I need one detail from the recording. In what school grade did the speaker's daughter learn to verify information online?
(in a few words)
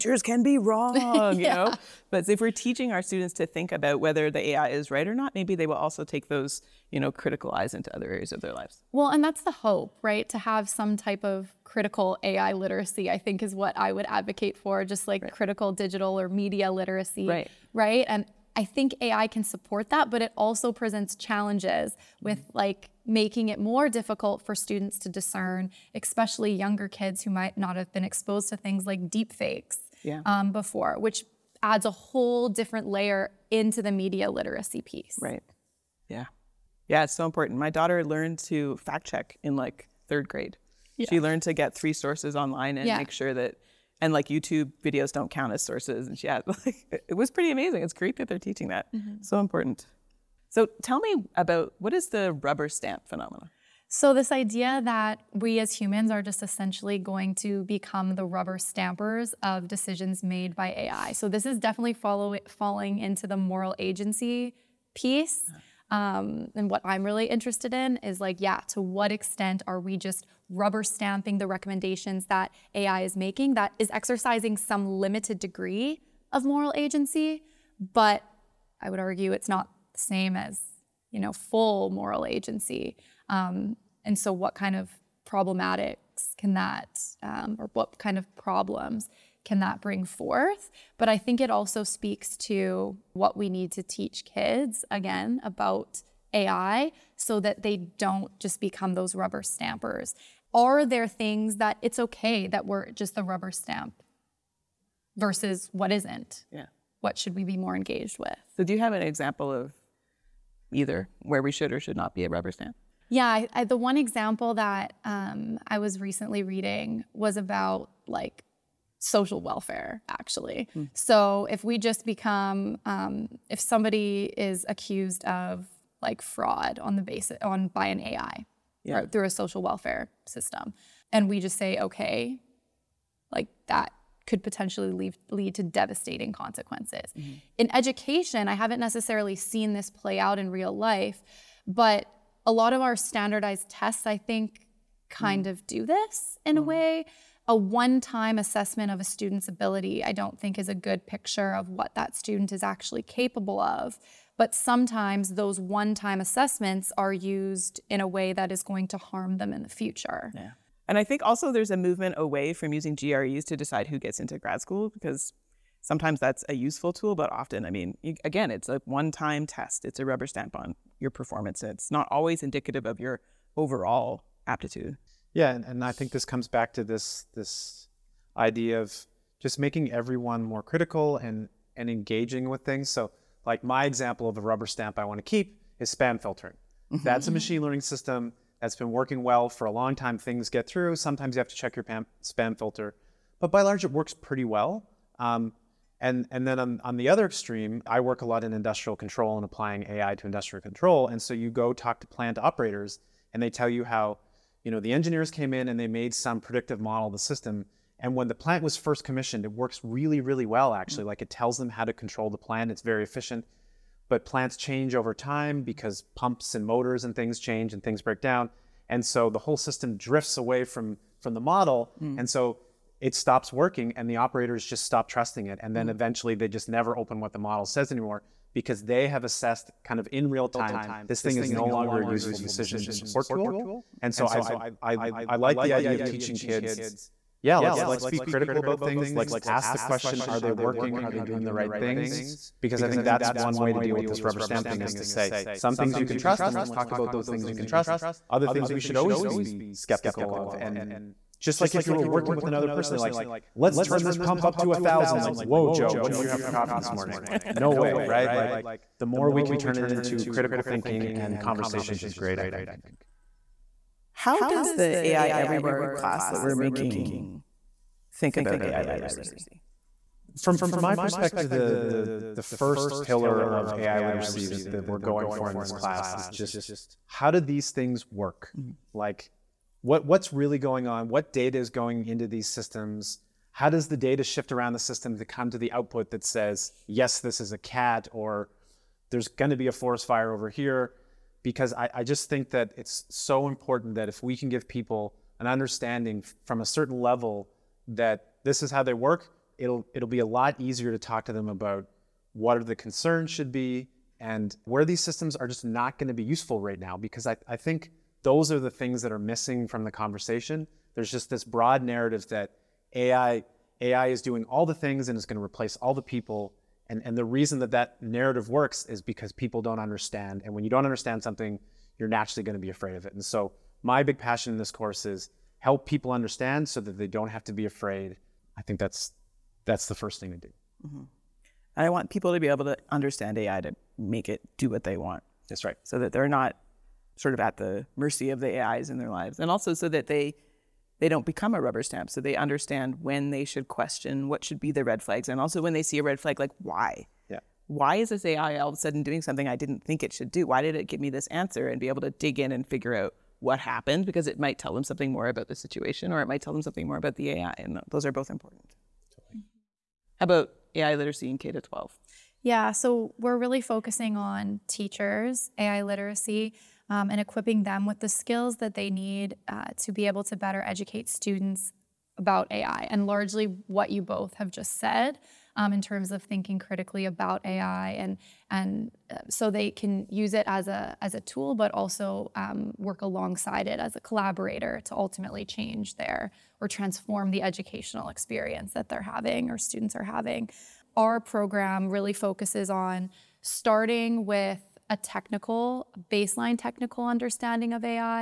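third grade.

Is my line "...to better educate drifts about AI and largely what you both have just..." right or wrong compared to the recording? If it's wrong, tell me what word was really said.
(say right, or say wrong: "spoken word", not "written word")
wrong: "students", not "drifts".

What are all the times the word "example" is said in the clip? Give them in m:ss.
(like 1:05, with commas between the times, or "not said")
1:49, 1:53, 3:03.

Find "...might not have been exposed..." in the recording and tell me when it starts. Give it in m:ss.
0:27.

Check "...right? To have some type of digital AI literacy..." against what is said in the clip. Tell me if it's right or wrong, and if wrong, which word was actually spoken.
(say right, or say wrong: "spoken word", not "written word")
wrong: "critical", not "digital".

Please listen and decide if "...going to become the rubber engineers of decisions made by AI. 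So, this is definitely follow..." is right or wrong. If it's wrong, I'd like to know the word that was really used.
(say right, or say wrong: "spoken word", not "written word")
wrong: "stampers", not "engineers".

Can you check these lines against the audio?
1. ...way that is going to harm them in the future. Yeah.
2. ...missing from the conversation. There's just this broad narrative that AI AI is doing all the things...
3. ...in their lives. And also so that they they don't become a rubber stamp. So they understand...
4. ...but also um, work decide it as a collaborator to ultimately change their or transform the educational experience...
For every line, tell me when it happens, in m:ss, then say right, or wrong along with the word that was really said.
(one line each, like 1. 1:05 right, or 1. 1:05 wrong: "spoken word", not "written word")
1. 2:38 right
2. 5:09 right
3. 5:38 right
4. 6:21 wrong: "alongside", not "decide".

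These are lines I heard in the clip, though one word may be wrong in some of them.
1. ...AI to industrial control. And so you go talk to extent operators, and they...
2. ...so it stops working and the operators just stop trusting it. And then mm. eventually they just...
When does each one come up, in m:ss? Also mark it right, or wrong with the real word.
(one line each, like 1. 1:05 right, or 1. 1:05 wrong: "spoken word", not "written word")
1. 3:19 wrong: "plant", not "extent"
2. 3:42 right.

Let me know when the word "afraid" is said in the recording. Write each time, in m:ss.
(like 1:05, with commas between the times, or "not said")
5:22, 5:27.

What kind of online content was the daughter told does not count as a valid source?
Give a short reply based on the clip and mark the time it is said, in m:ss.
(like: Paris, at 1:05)
YouTube videos, at 0:44.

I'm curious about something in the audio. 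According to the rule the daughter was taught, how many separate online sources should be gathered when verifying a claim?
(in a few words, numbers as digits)
3.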